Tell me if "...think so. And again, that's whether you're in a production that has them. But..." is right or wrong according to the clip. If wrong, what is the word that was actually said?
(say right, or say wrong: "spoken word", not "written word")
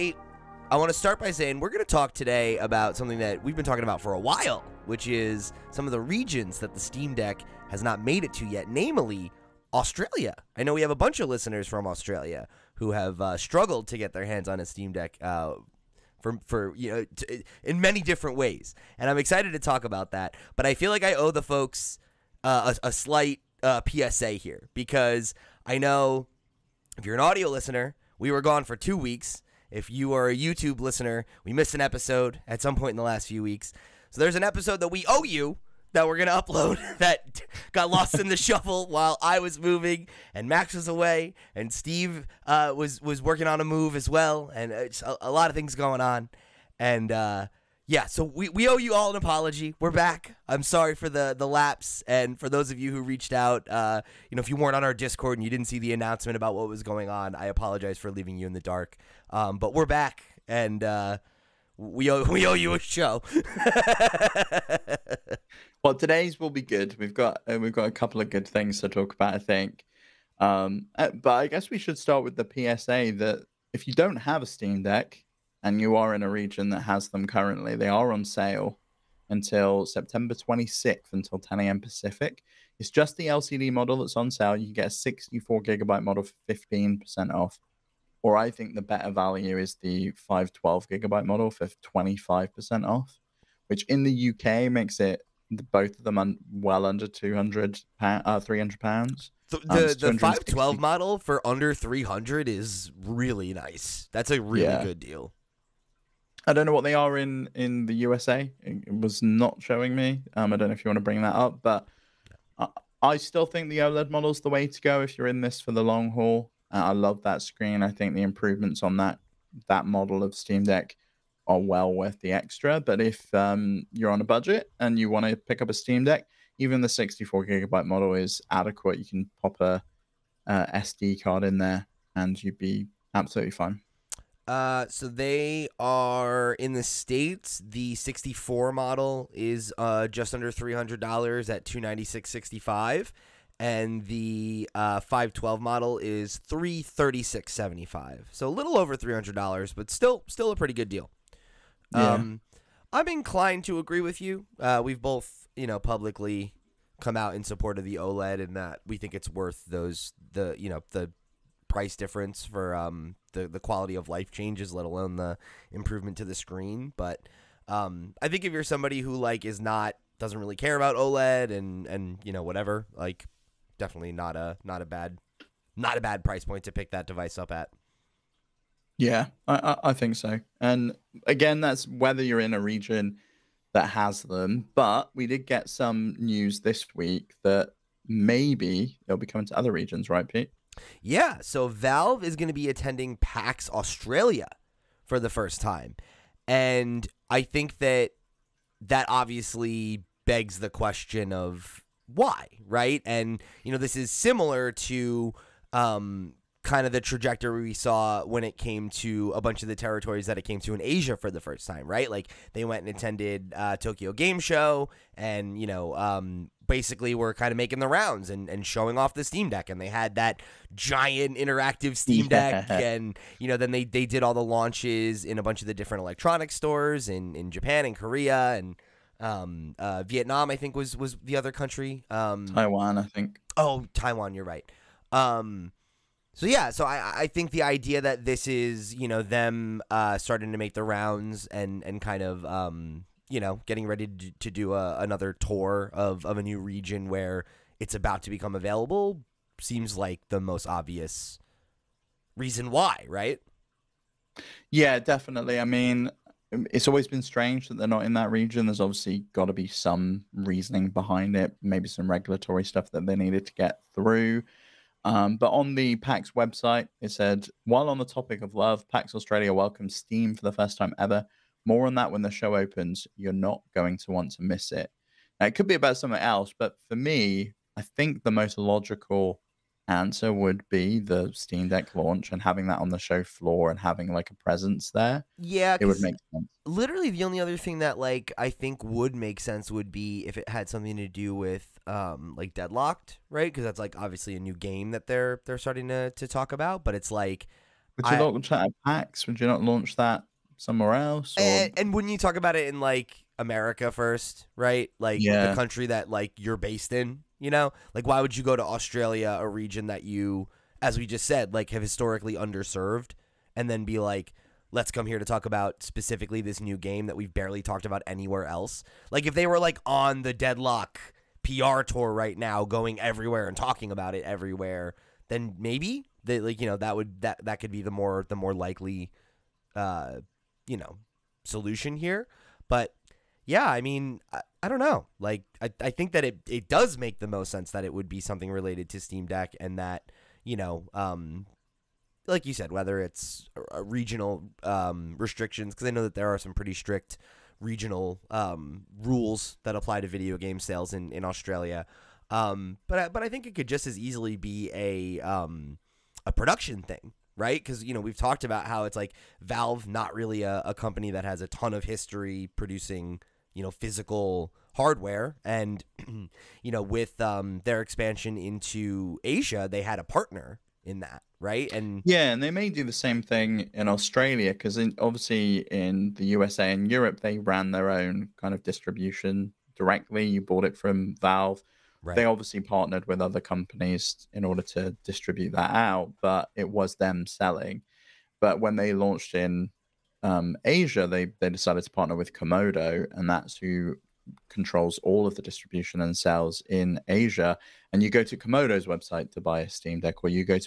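wrong: "region", not "production".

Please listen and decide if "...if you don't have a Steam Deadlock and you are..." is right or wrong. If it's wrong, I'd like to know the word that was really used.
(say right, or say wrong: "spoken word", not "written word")
wrong: "Deck", not "Deadlock".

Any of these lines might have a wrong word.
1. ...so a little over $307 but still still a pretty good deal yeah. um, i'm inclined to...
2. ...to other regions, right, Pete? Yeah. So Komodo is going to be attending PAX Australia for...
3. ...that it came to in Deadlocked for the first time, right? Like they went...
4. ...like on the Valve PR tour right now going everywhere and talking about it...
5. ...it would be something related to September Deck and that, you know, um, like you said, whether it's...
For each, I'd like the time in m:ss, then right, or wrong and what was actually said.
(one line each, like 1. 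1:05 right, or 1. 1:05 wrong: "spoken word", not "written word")
1. 2:28 wrong: "300", not "307"
2. 3:09 wrong: "Valve", not "Komodo"
3. 3:30 wrong: "Asia", not "Deadlocked"
4. 5:19 wrong: "Deadlock", not "Valve"
5. 5:37 wrong: "Steam", not "September".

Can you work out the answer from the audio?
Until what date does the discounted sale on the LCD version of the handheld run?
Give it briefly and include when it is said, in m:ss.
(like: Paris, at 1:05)
September 26th, at 1:19.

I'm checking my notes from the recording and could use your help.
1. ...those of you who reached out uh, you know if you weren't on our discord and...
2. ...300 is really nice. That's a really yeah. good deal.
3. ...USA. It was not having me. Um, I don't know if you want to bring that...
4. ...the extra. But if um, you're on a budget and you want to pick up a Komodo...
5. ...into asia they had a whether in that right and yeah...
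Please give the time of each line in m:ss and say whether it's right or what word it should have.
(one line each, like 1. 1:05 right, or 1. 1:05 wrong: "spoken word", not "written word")
1. 0:52 right
2. 1:41 right
3. 1:48 wrong: "showing", not "having"
4. 2:02 wrong: "Steam", not "Komodo"
5. 6:08 wrong: "partner", not "whether".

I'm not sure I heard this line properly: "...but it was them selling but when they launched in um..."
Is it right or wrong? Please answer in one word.
right.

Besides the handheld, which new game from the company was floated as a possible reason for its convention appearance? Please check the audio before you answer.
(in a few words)
Deadlock.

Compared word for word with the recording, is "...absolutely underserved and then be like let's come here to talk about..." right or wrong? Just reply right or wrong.
wrong.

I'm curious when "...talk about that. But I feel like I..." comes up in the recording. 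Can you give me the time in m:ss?
0:19.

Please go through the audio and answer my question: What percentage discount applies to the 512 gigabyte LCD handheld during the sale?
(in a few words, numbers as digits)
25%.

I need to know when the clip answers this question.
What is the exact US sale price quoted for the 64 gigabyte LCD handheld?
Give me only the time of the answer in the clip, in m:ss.
2:21.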